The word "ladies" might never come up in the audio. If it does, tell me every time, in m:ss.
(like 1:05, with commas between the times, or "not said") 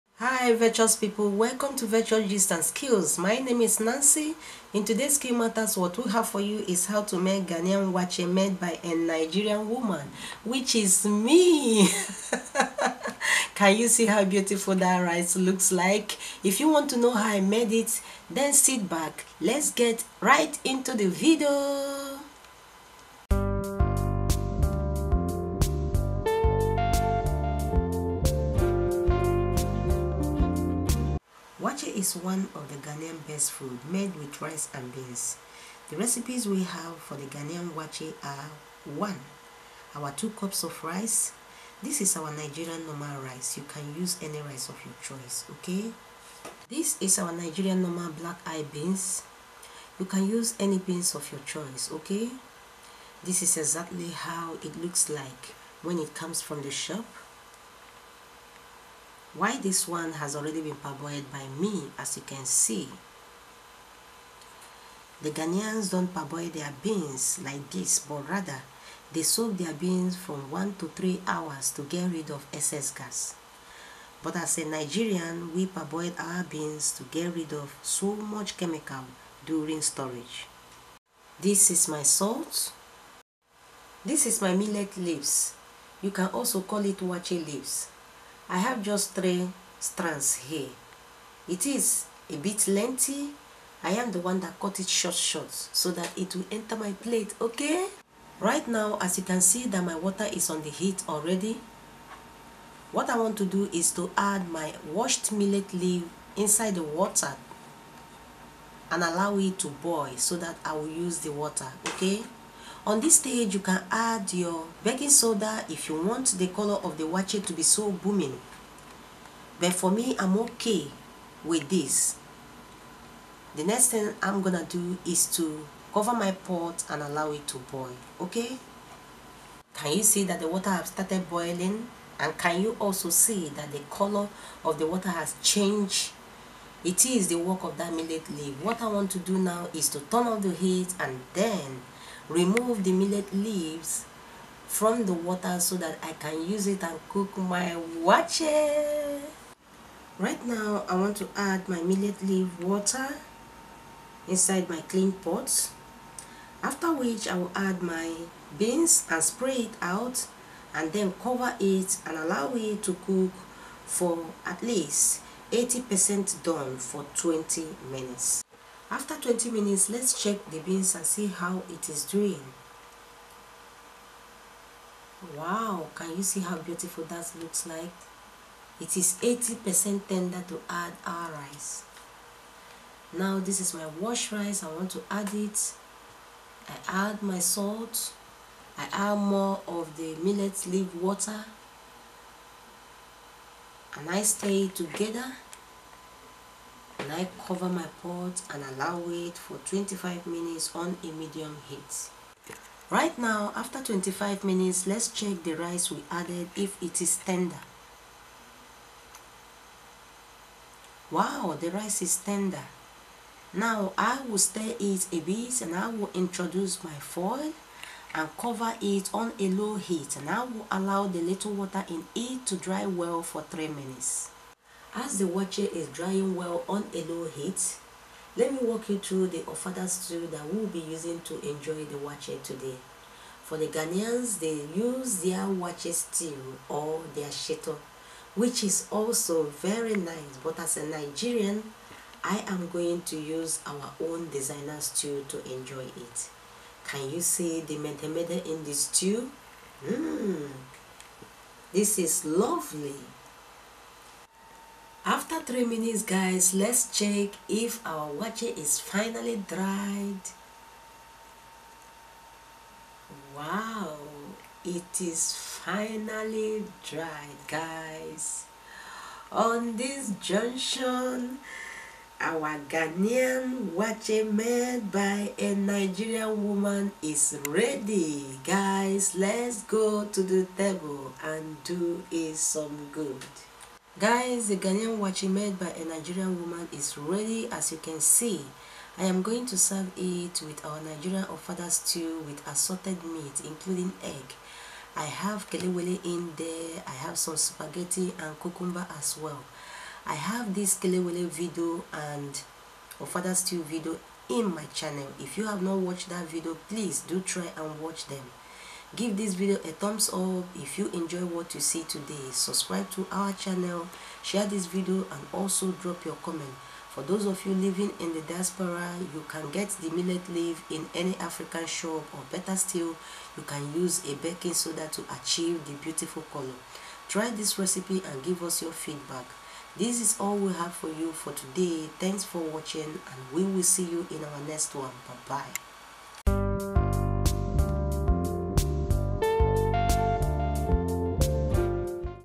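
not said.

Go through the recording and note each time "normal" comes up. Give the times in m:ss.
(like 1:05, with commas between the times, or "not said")
0:42, 0:47.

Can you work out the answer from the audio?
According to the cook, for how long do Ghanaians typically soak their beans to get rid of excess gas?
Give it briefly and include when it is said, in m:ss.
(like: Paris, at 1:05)
1 to 3 hours, at 1:10.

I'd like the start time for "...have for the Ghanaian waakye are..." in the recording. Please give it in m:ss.
0:36.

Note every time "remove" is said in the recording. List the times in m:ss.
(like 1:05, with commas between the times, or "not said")
2:22.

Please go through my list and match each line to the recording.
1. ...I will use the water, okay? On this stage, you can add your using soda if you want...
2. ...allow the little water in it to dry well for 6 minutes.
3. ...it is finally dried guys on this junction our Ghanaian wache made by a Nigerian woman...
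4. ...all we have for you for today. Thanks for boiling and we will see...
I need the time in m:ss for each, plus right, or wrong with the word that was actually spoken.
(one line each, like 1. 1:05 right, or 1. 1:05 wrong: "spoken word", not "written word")
1. 1:50 wrong: "baking", not "using"
2. 3:40 wrong: "3", not "6"
3. 4:24 right
4. 5:30 wrong: "watching", not "boiling".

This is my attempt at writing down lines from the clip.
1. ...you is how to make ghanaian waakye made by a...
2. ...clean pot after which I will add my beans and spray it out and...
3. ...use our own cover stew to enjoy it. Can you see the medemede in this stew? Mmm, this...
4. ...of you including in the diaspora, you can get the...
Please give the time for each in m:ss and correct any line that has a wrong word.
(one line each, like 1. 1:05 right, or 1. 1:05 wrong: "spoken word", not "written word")
1. 0:06 right
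2. 2:34 right
3. 4:03 wrong: "designer", not "cover"
4. 5:17 wrong: "living", not "including".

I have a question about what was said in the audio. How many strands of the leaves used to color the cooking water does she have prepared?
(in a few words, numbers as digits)
3.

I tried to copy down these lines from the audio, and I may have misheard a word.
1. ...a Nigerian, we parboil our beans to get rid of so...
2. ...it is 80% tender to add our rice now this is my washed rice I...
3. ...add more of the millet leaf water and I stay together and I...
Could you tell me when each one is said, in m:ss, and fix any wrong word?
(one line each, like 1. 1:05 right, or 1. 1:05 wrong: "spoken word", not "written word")
1. 1:14 right
2. 2:58 right
3. 3:08 right.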